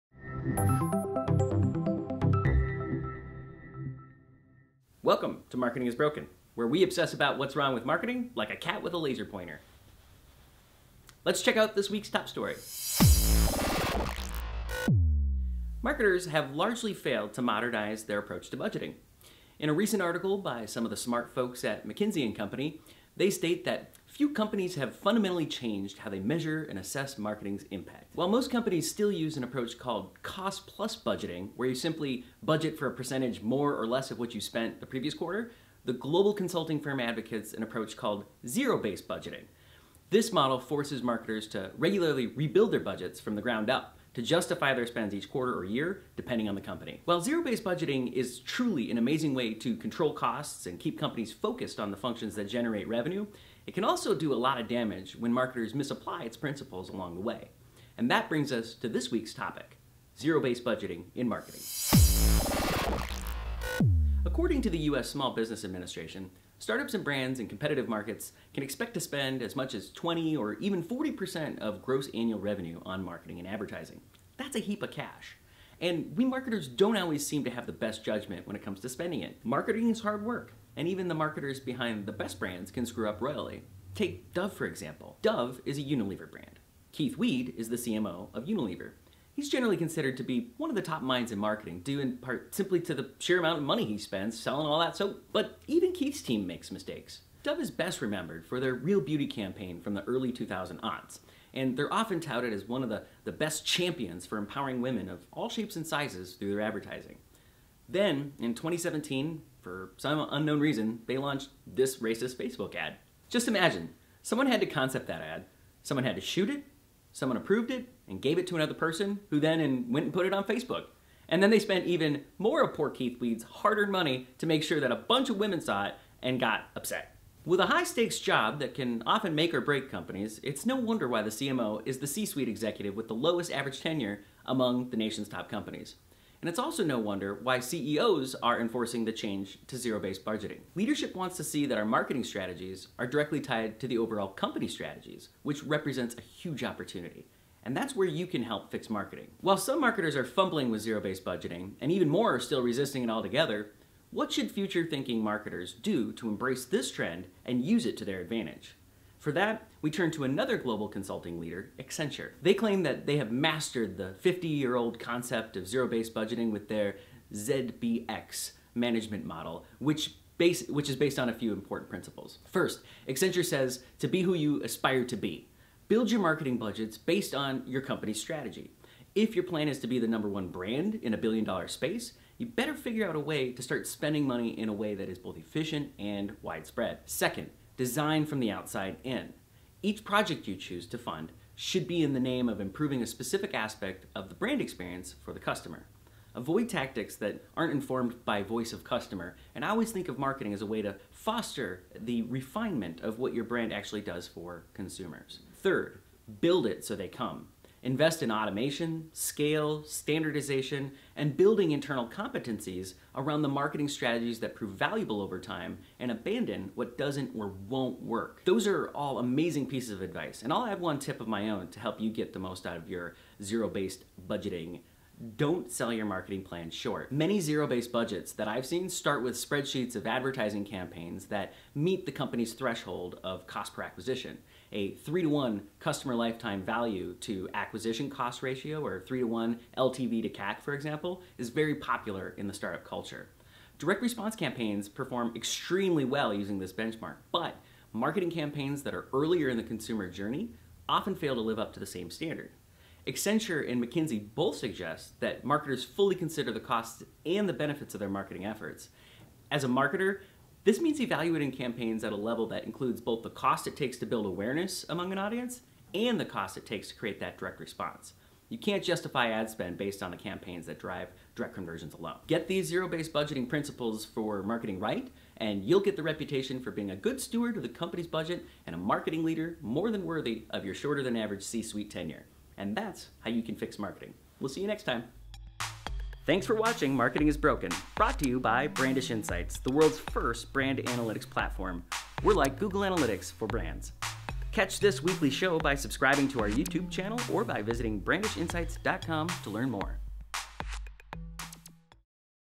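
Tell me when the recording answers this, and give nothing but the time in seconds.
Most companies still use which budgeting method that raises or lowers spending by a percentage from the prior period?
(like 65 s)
30 s.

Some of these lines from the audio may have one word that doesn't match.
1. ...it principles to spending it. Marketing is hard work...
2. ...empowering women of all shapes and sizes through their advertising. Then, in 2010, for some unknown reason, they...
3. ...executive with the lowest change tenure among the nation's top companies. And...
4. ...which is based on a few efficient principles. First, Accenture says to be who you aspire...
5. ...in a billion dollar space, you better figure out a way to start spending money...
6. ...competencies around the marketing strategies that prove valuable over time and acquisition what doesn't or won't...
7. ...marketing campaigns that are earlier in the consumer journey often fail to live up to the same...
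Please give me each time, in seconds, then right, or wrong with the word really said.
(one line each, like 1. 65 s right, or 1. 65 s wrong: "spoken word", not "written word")
1. 78 s wrong: "comes", not "principles"
2. 104 s wrong: "2017", not "2010"
3. 132 s wrong: "average", not "change"
4. 170 s wrong: "important", not "efficient"
5. 180 s right
6. 212 s wrong: "abandon", not "acquisition"
7. 247 s right.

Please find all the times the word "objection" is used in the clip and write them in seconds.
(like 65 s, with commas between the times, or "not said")
not said.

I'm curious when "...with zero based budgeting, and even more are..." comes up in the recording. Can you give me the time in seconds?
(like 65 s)
150 s.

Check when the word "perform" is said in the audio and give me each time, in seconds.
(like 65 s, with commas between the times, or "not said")
244 s.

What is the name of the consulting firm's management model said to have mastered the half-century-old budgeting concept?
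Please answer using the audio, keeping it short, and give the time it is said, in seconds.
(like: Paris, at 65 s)
ZBX, at 167 s.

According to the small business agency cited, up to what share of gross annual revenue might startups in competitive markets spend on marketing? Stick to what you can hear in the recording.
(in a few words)
40%.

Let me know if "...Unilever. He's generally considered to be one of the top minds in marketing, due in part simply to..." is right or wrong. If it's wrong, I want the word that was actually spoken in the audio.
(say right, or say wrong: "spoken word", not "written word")
right.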